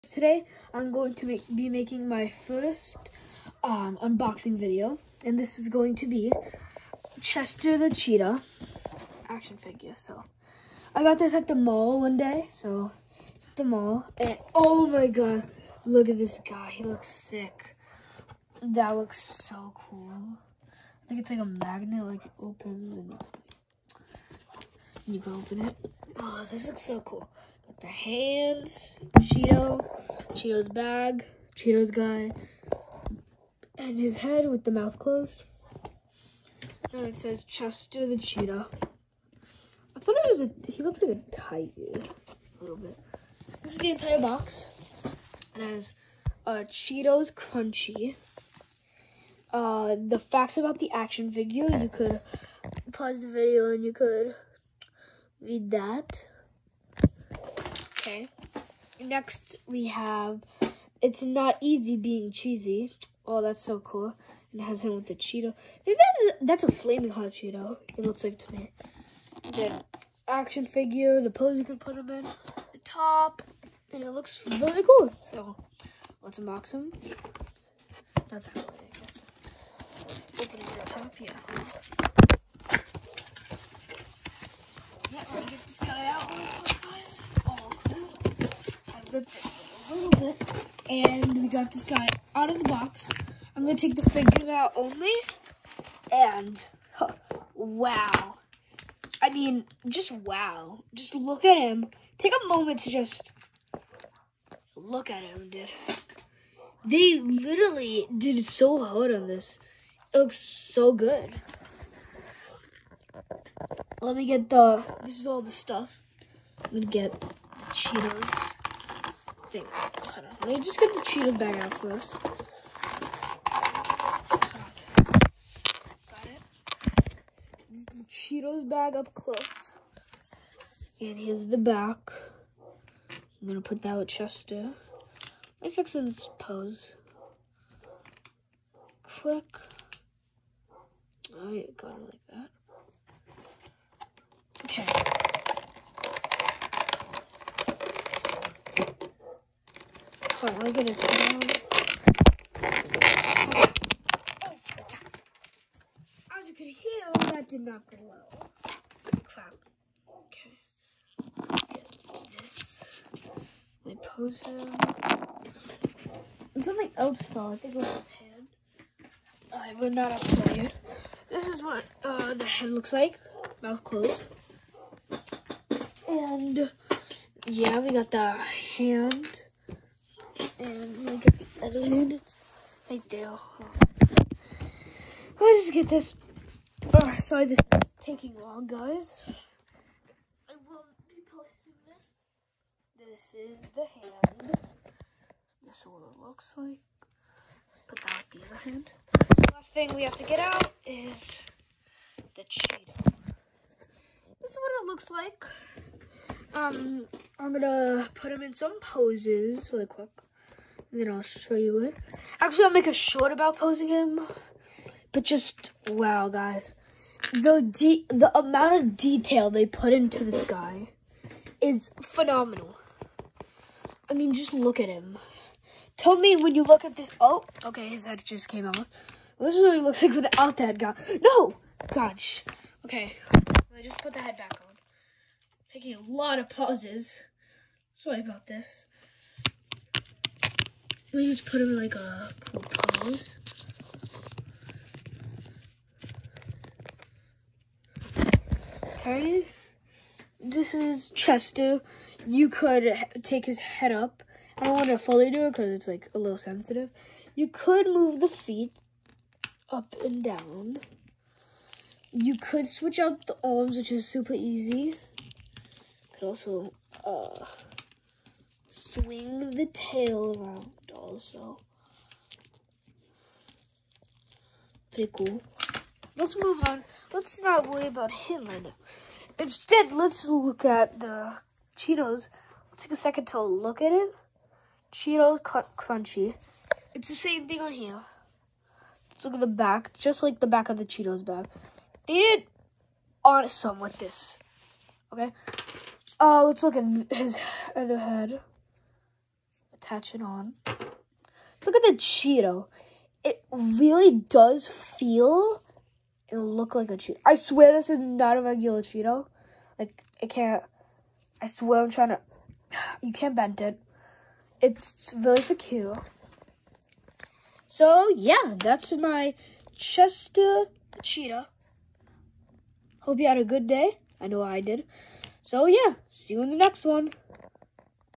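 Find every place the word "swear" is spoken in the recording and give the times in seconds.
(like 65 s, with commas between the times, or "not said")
307 s, 311 s.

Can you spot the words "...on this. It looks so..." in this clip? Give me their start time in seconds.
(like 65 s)
109 s.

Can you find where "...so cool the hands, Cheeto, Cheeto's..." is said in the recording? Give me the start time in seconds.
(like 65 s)
26 s.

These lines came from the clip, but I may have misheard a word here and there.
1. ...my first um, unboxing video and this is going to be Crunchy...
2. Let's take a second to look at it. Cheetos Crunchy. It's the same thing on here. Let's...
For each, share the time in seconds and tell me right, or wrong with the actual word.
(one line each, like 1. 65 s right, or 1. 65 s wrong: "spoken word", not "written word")
1. 2 s wrong: "Chester", not "Crunchy"
2. 282 s right.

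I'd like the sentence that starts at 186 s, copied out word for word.
Oh, sorry, this is taking long, guys.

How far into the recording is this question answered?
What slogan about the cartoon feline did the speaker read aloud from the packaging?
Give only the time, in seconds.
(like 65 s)
61 s.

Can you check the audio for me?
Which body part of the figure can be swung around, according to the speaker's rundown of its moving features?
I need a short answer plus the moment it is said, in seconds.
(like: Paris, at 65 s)
The tail, at 269 s.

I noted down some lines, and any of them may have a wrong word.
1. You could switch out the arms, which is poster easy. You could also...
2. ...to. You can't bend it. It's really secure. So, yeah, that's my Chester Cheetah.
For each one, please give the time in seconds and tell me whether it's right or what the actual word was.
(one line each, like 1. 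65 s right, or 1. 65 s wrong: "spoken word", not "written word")
1. 262 s wrong: "super", not "poster"
2. 312 s right.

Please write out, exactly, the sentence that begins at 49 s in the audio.
Uh, the facts about the action figure, you could pause the video and you could read that.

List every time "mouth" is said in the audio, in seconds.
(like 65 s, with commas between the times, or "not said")
34 s, 173 s.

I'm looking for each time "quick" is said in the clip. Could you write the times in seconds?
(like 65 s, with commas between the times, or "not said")
139 s, 209 s.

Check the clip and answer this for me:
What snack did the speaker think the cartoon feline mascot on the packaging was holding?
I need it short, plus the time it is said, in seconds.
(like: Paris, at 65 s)
Flaming hot Cheeto, at 66 s.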